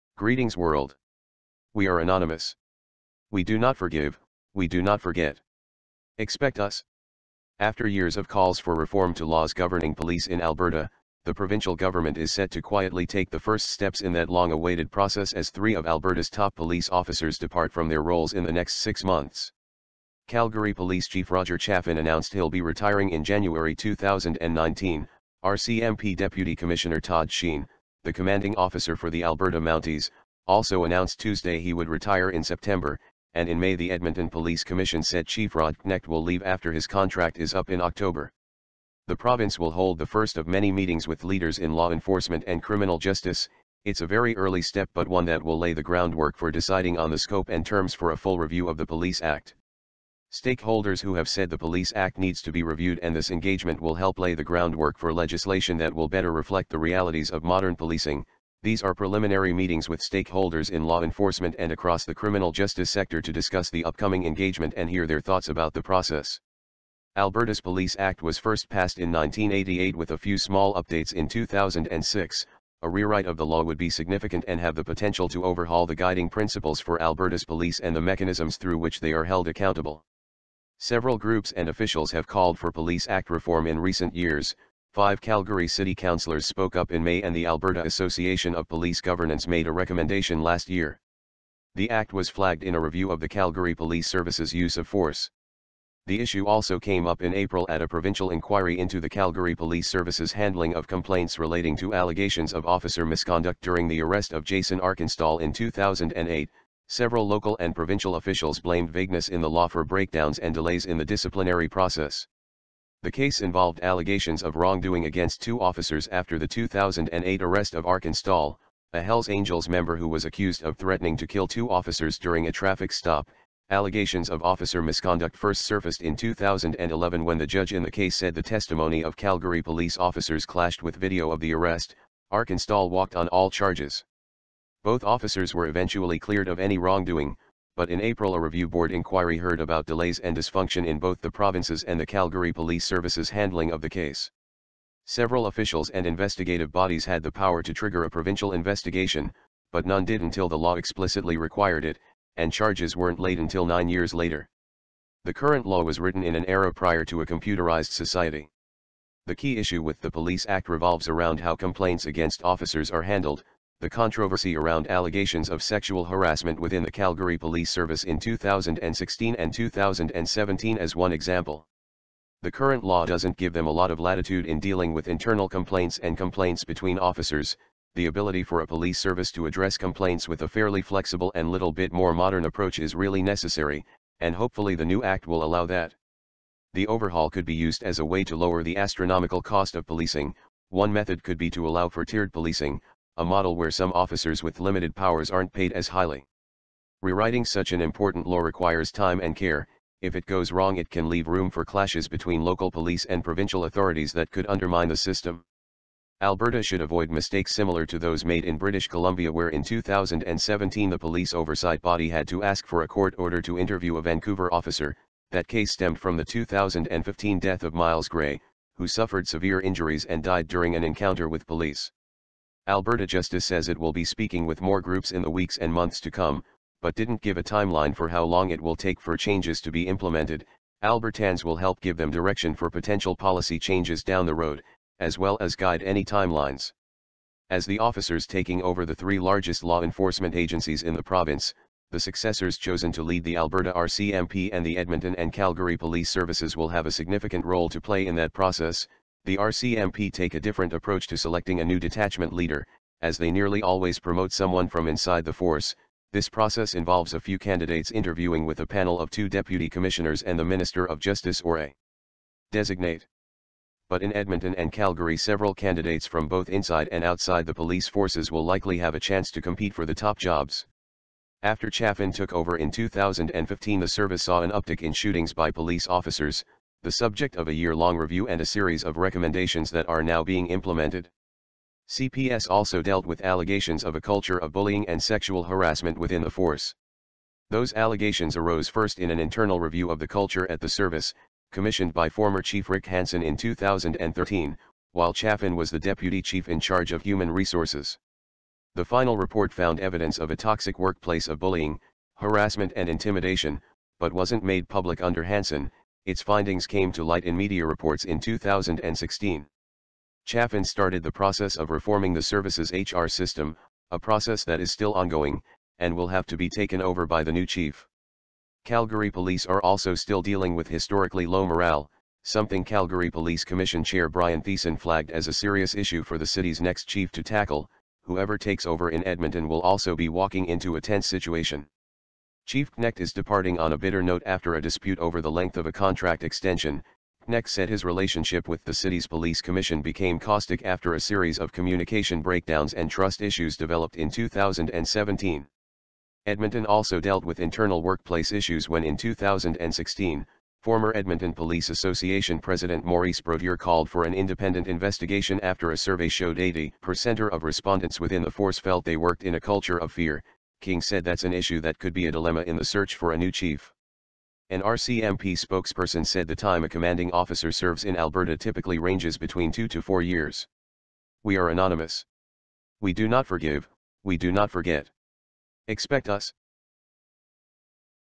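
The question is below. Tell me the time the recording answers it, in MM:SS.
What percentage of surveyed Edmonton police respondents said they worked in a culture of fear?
05:56.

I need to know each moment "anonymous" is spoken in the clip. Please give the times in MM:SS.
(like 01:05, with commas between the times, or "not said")
00:01, 06:11.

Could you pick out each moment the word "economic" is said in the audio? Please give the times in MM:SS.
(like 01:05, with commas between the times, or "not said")
not said.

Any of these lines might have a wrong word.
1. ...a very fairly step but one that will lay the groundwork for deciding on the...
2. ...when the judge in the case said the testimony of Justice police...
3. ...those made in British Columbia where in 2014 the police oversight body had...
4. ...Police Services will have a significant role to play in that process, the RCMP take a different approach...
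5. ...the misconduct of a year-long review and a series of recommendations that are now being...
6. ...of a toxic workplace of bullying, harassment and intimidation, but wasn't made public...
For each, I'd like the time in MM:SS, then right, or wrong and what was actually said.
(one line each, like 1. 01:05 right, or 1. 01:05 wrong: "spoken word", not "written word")
1. 00:44 wrong: "early", not "fairly"
2. 02:07 wrong: "Calgary", not "Justice"
3. 03:27 wrong: "2017", not "2014"
4. 04:05 right
5. 04:36 wrong: "subject", not "misconduct"
6. 05:00 right.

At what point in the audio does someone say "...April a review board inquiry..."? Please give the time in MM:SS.
02:18.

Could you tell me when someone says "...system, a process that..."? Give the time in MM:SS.
05:13.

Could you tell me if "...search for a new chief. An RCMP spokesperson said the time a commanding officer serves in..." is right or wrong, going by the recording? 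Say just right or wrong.
right.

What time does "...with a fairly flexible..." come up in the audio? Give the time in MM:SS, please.
03:00.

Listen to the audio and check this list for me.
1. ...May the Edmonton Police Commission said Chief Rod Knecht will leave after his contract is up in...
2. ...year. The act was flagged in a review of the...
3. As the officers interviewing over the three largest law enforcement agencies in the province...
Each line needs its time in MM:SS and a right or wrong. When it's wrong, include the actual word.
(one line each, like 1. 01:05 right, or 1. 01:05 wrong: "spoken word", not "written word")
1. 00:33 right
2. 01:30 right
3. 03:57 wrong: "taking", not "interviewing".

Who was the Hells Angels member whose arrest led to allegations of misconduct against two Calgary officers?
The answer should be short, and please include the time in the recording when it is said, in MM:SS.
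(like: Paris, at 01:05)
Jason Arkinstall, at 01:44.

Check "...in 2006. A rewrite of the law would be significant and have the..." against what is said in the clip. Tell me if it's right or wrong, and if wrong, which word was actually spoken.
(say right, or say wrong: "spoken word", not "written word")
right.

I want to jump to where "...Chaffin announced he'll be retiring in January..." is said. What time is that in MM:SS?
00:21.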